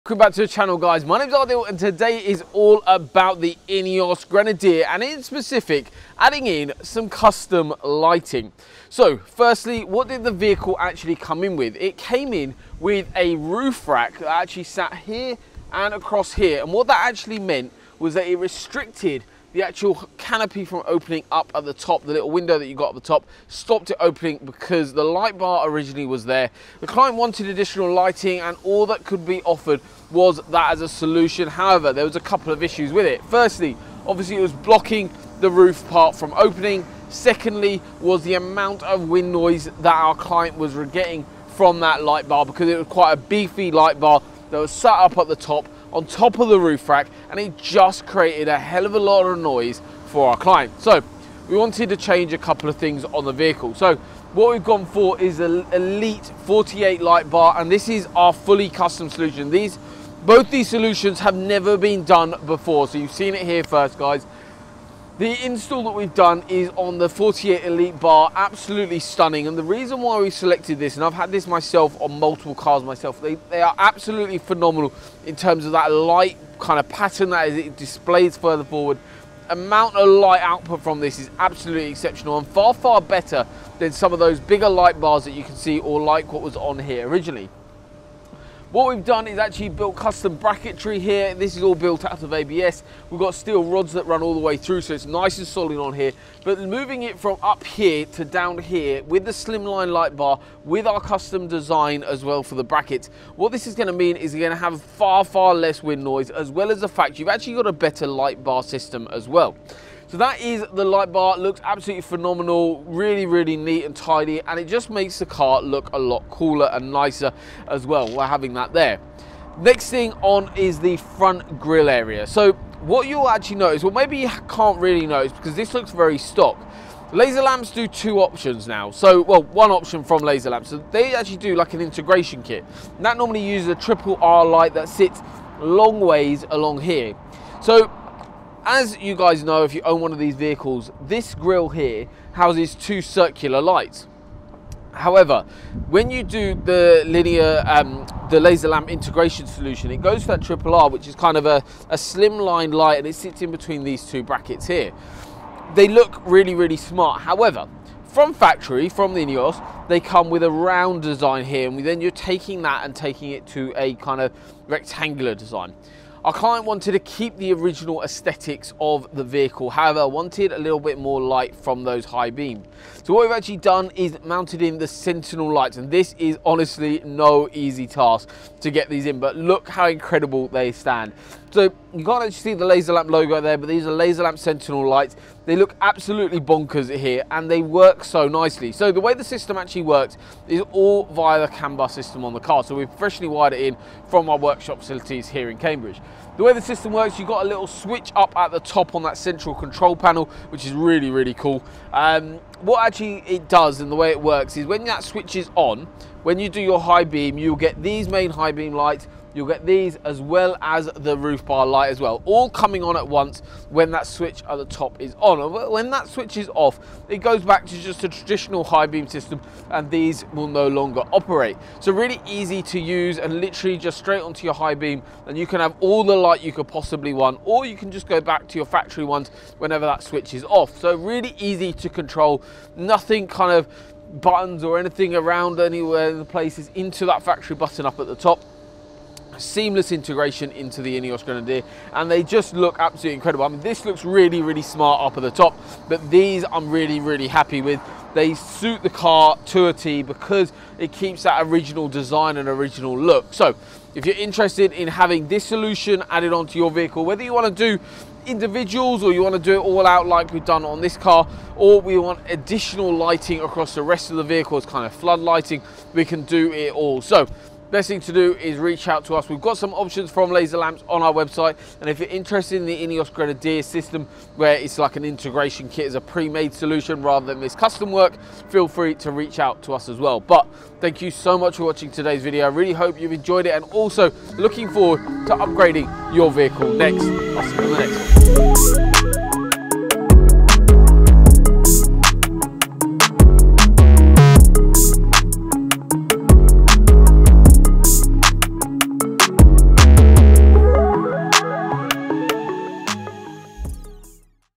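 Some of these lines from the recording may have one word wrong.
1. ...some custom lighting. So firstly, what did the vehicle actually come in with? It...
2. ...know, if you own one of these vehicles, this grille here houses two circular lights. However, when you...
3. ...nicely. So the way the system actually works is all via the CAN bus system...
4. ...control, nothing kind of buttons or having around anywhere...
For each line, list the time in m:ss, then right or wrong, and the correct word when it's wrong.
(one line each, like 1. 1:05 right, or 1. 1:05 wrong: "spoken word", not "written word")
1. 0:06 right
2. 2:19 right
3. 3:08 right
4. 3:51 wrong: "anything", not "having".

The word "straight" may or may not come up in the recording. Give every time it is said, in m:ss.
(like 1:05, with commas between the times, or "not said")
3:43.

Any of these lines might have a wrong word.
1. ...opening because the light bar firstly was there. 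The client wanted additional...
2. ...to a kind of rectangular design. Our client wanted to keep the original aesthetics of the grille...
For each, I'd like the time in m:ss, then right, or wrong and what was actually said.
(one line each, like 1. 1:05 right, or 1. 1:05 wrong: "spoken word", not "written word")
1. 0:23 wrong: "originally", not "firstly"
2. 2:43 wrong: "vehicle", not "grille".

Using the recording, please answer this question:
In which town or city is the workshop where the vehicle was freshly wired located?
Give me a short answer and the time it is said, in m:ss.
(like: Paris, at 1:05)
Cambridge, at 3:15.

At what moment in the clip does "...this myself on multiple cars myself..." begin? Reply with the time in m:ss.
1:11.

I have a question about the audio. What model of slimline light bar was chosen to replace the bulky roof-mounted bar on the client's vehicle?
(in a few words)
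Elite 48.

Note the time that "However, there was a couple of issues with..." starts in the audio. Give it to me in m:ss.
0:31.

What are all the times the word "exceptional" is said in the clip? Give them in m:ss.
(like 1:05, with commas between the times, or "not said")
1:21.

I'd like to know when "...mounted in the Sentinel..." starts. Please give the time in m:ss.
2:54.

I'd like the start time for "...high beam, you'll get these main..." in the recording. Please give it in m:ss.
3:26.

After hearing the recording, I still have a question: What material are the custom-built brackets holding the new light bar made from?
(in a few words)
ABS.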